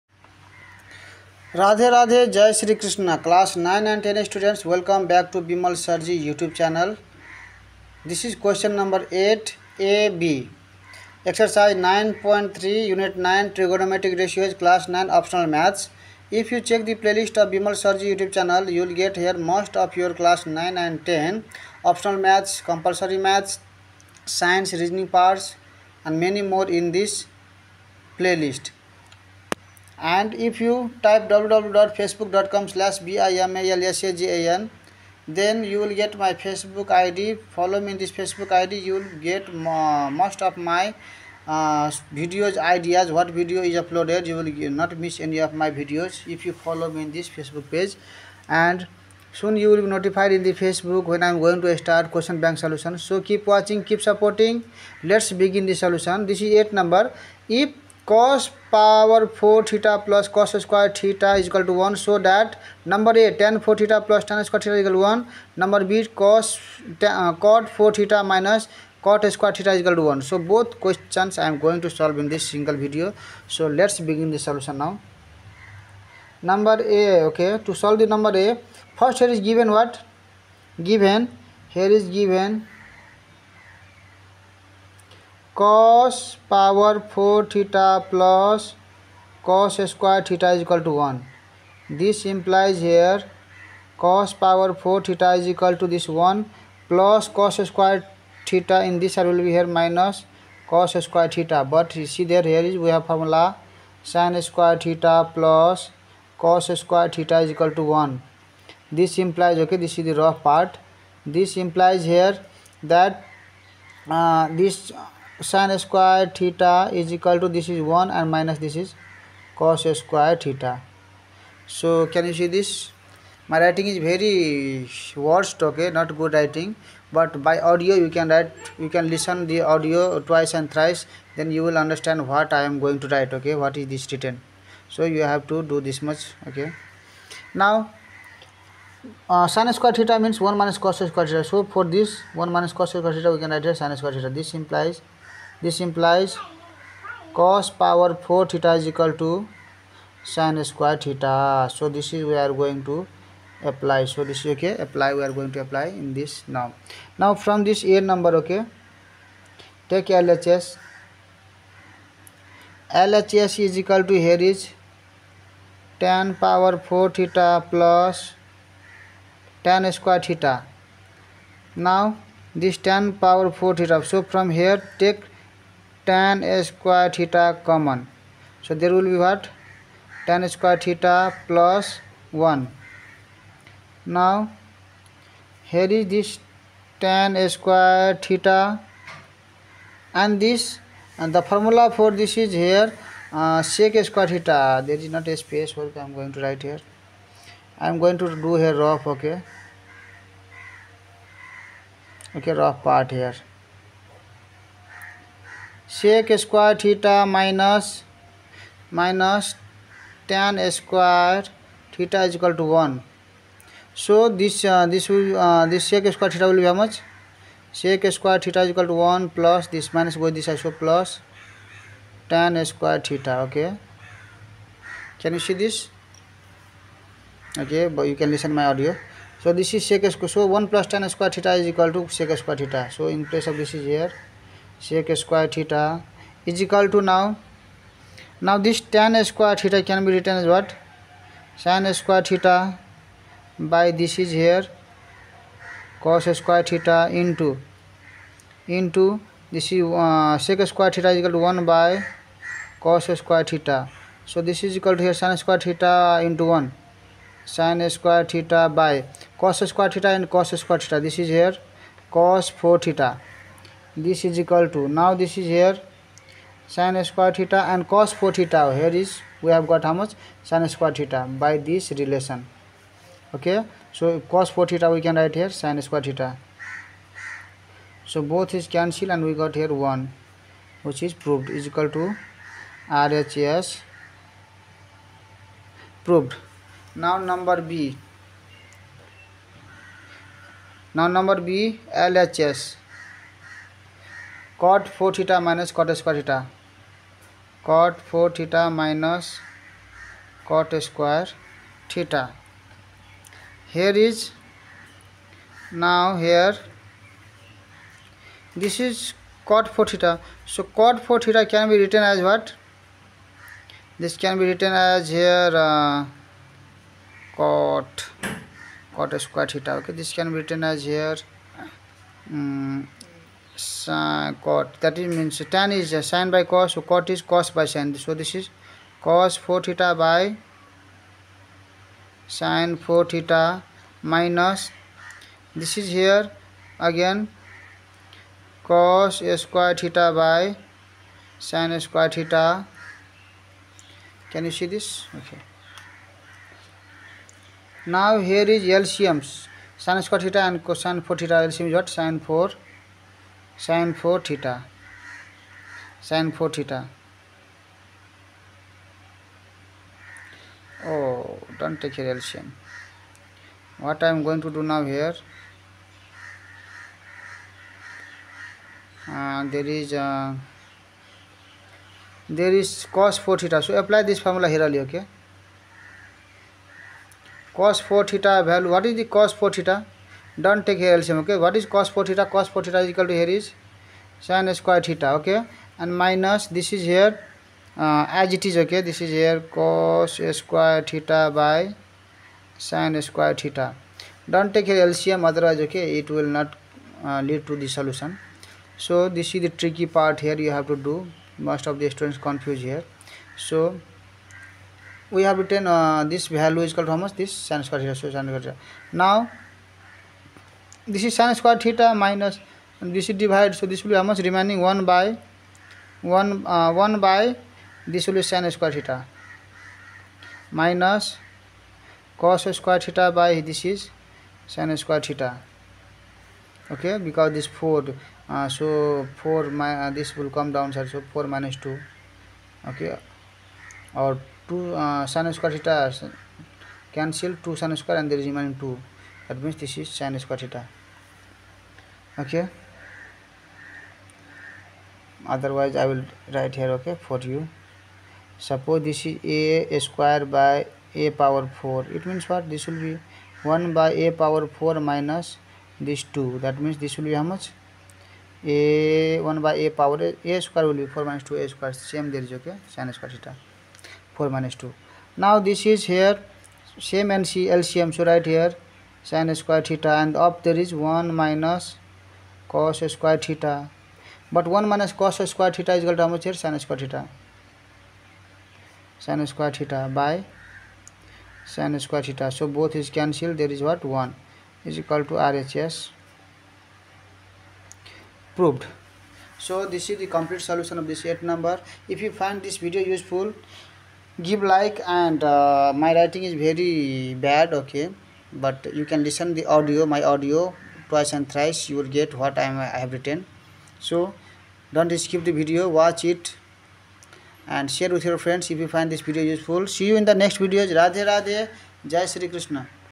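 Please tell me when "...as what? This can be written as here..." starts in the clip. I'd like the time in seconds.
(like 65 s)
312 s.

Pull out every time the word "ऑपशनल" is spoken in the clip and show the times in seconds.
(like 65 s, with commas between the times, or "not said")
15 s, 21 s.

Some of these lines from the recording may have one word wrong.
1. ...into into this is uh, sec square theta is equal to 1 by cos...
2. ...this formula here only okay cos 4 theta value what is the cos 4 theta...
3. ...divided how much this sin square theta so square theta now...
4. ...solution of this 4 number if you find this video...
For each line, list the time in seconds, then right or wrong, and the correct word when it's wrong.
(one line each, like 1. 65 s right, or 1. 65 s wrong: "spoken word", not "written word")
1. 247 s right
2. 374 s right
3. 406 s wrong: "called", not "divided"
4. 490 s wrong: "8", not "4".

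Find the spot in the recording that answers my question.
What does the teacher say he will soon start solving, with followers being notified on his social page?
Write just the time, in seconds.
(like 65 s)
52 s.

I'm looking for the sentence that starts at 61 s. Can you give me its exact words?
So that number A, tan 4 theta plus tan square theta is equal to 1.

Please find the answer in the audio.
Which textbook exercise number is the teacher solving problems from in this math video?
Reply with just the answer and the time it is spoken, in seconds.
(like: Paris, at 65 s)
9.3, at 11 s.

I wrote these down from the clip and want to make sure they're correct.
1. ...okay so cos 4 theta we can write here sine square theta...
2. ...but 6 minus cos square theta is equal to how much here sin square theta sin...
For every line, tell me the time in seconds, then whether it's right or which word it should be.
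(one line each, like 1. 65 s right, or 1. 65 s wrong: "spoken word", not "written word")
1. 273 s right
2. 474 s wrong: "1", not "6".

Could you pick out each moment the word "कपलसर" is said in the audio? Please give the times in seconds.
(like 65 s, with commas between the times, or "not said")
22 s.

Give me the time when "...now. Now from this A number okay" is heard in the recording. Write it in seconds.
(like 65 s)
156 s.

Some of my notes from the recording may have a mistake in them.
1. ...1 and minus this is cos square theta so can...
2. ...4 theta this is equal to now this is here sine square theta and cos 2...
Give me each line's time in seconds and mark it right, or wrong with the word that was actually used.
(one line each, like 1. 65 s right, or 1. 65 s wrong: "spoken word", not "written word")
1. 117 s right
2. 262 s wrong: "4", not "2".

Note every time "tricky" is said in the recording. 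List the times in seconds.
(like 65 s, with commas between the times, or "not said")
399 s.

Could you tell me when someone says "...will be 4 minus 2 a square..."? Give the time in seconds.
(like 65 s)
460 s.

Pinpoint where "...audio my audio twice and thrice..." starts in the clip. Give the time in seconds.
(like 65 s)
499 s.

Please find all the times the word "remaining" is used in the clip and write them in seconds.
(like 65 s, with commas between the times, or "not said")
414 s, 438 s.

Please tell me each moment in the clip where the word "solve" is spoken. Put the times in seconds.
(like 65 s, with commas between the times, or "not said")
71 s, 77 s.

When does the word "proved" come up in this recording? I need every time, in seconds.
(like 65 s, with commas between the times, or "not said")
281 s, 286 s, 488 s.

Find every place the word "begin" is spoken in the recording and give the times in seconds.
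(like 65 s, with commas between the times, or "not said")
55 s, 73 s.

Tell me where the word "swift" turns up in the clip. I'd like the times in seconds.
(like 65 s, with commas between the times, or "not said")
not said.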